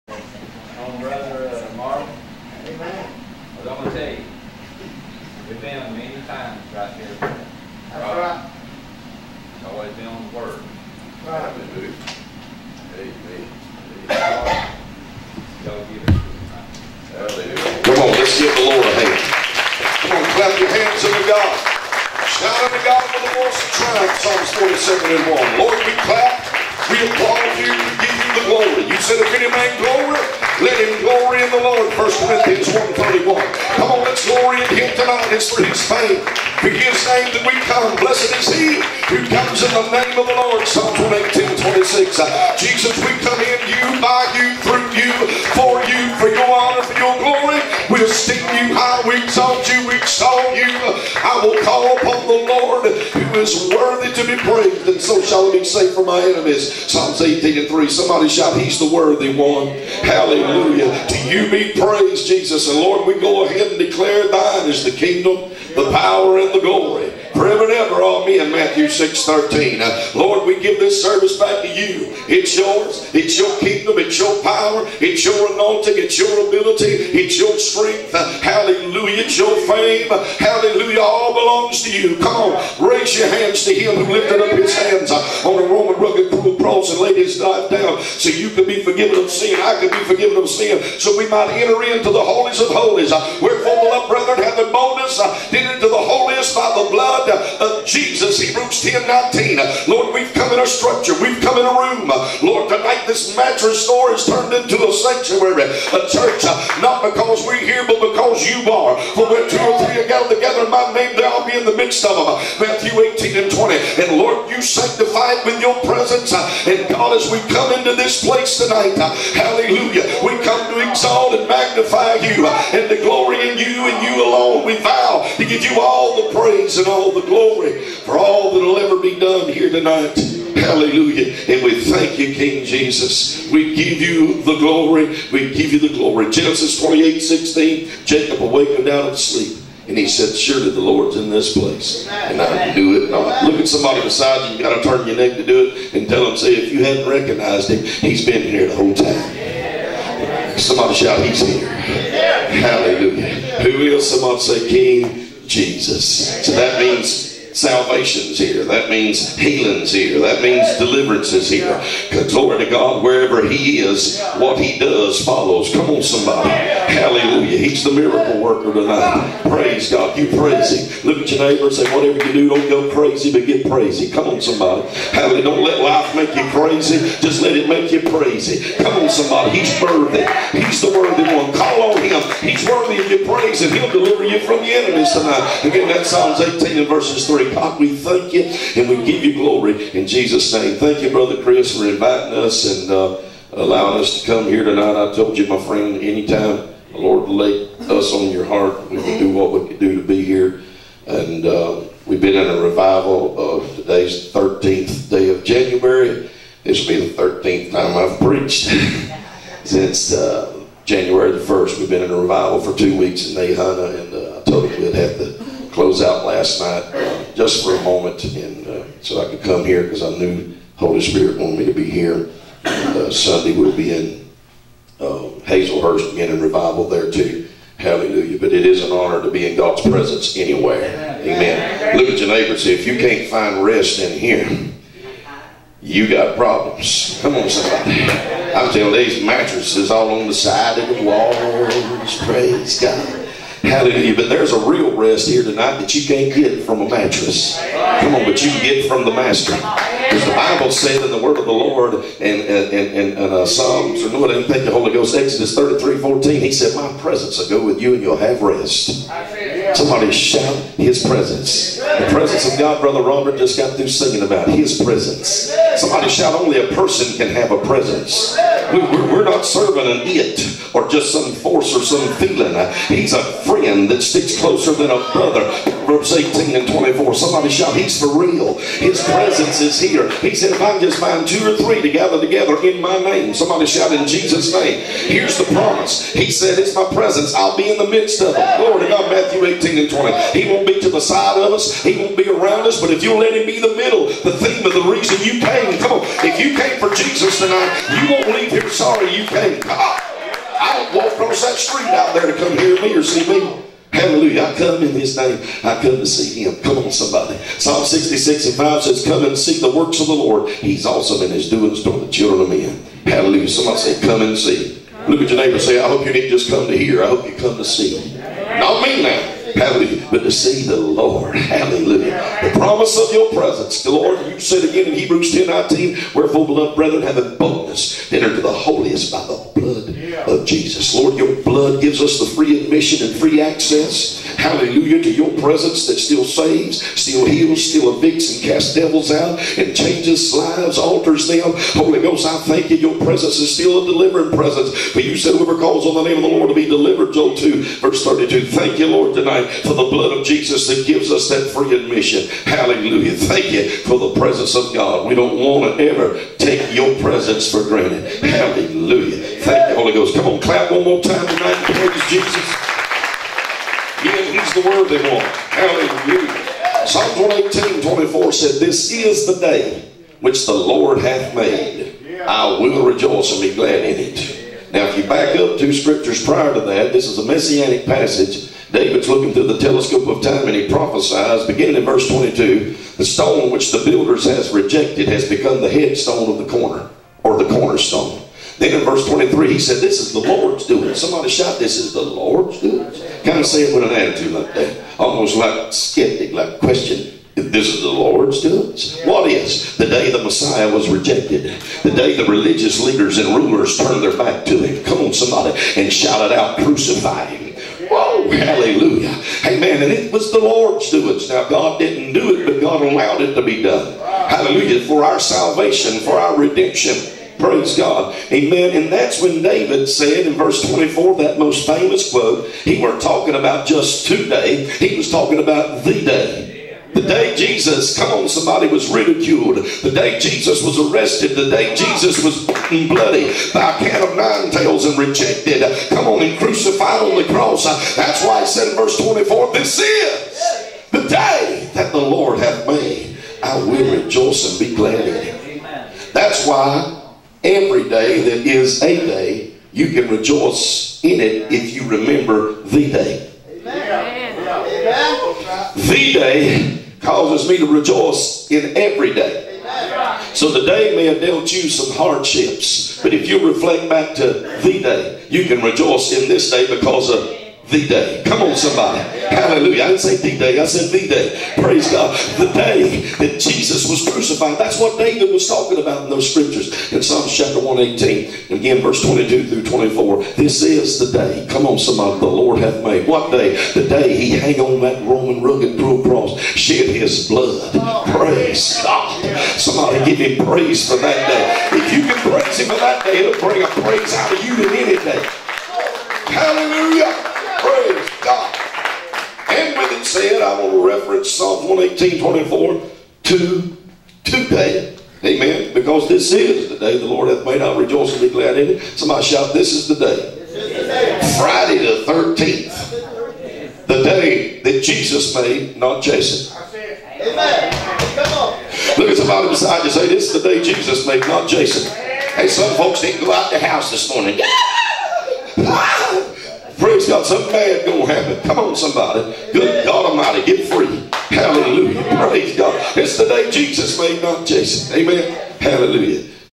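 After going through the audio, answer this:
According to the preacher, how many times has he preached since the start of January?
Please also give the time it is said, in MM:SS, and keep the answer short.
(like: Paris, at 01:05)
13, at 03:27.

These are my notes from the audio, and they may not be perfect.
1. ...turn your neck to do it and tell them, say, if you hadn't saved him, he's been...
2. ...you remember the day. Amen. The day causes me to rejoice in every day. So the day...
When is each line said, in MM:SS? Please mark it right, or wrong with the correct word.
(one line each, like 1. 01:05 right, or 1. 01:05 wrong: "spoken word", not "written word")
1. 02:24 wrong: "recognized", not "saved"
2. 07:31 right.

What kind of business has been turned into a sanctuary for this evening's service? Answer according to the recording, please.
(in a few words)
Mattress store.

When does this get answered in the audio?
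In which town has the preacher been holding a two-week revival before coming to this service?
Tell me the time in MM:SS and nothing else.
03:33.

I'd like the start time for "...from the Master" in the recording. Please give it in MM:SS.
04:08.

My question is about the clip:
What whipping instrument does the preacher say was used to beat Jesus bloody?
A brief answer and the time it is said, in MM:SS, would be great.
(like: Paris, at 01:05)
Cat of nine tails, at 07:13.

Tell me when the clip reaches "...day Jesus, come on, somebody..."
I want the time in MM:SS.
07:07.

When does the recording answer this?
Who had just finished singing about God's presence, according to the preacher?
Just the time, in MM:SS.
04:22.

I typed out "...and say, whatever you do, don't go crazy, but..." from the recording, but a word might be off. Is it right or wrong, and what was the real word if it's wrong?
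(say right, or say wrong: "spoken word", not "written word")
right.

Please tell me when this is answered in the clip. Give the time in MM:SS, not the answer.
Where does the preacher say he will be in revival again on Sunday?
03:45.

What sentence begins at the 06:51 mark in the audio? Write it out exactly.
Now, God didn't do it, but God allowed it to be done.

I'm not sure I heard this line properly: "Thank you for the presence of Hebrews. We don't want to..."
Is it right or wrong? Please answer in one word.
wrong.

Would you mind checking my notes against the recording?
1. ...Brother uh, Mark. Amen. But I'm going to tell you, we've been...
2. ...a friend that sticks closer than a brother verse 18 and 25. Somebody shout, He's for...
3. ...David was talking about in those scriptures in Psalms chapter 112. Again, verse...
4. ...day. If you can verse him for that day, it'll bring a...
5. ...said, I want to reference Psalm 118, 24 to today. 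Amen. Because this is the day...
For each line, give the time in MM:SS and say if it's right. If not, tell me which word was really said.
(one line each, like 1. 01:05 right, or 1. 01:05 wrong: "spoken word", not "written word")
1. 00:00 right
2. 04:33 wrong: "24", not "25"
3. 07:54 wrong: "118", not "112"
4. 08:11 wrong: "praise", not "verse"
5. 08:20 right.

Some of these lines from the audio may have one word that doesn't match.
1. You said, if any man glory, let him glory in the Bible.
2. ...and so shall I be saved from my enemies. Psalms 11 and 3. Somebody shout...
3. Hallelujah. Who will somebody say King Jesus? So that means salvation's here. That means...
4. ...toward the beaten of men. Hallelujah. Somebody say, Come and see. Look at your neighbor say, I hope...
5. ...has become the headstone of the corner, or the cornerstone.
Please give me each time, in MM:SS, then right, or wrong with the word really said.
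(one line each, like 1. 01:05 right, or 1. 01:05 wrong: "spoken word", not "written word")
1. 00:28 wrong: "Lord", not "Bible"
2. 00:54 wrong: "18", not "11"
3. 02:31 right
4. 05:11 wrong: "children", not "beaten"
5. 06:25 right.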